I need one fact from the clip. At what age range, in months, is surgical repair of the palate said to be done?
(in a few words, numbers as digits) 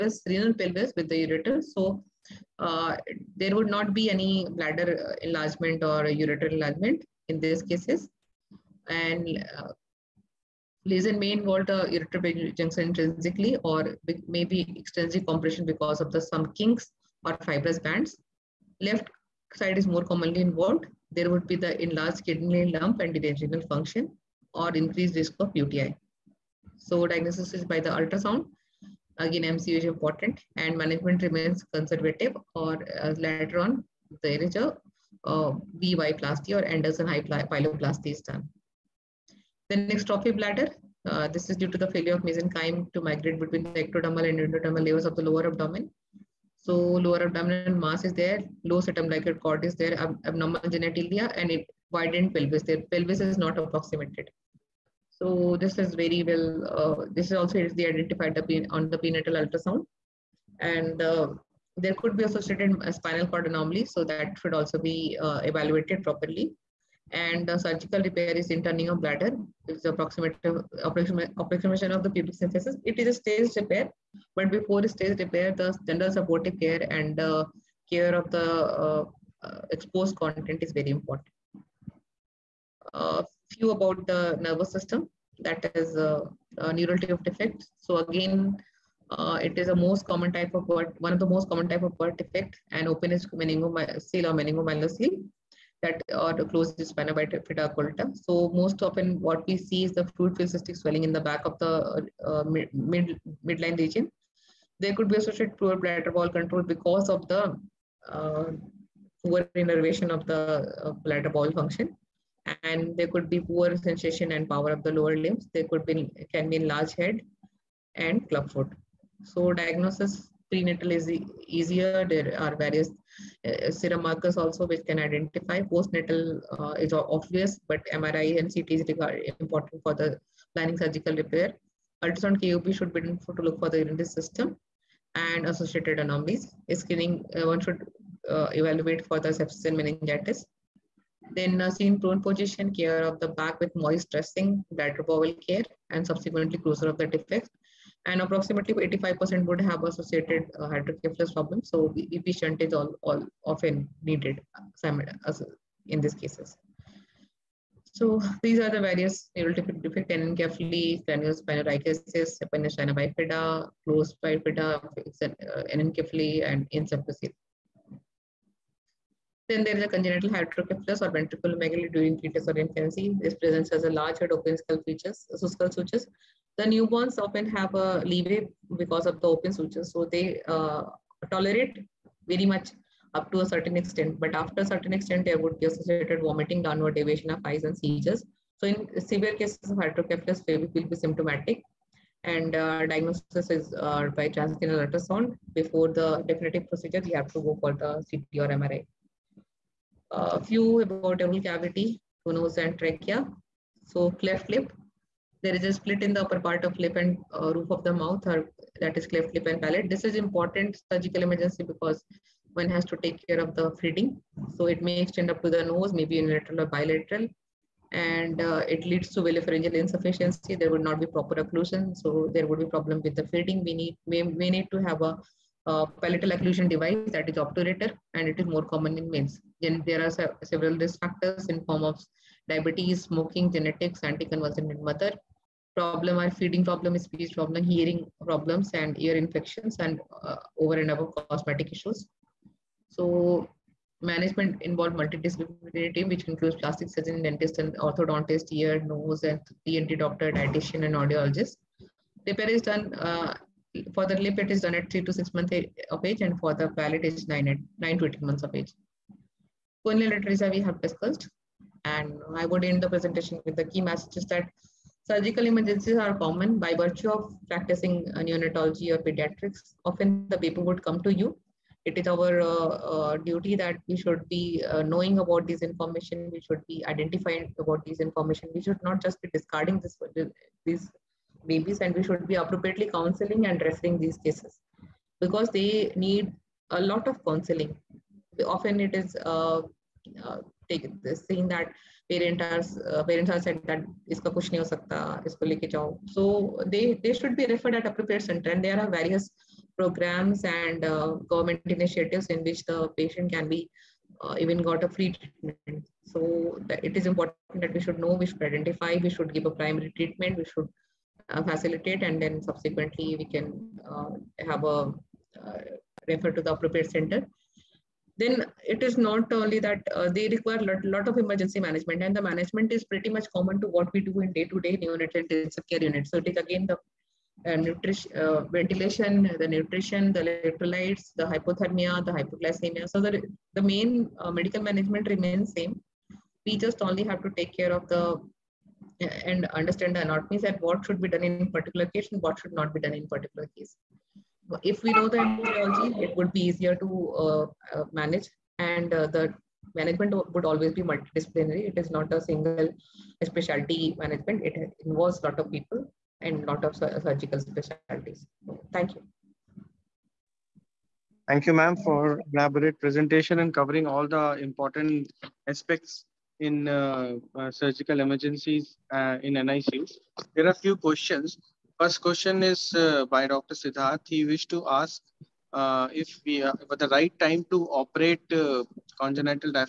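9 to 18 months.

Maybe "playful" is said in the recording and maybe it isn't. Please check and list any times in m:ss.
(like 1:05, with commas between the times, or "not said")
not said.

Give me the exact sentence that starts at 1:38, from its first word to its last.
So most often what we see is the fluid filled cystic swelling in the back of the uh, mid, mid, midline region.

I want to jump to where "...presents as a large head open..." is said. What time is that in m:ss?
2:53.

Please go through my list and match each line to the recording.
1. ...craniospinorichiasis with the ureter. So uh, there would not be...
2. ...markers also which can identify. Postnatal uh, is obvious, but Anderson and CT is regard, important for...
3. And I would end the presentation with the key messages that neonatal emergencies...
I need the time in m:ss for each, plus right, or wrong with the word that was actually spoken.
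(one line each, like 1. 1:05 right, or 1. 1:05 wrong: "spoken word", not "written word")
1. 0:00 wrong: "pelvis", not "craniospinorichiasis"
2. 2:04 wrong: "MRI", not "Anderson"
3. 4:21 wrong: "surgical", not "neonatal".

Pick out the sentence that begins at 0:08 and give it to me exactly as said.
And uh, lesion may involve the ureter junction intrinsically or maybe extensive compression because of the some kinks or fibrous bands.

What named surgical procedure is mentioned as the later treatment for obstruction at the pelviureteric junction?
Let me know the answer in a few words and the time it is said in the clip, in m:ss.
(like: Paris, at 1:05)
Anderson pyeloplasty, at 0:36.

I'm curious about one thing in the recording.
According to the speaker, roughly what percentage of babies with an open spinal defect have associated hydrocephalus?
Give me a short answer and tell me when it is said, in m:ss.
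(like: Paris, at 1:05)
85%, at 2:28.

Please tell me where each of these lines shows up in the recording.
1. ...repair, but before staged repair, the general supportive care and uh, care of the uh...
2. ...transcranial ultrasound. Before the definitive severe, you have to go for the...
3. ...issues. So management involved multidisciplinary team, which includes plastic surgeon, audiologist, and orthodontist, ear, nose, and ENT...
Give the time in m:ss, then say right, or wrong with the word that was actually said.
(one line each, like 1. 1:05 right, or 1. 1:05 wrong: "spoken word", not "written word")
1. 1:13 right
2. 3:14 wrong: "procedure", not "severe"
3. 4:01 wrong: "dentist", not "audiologist".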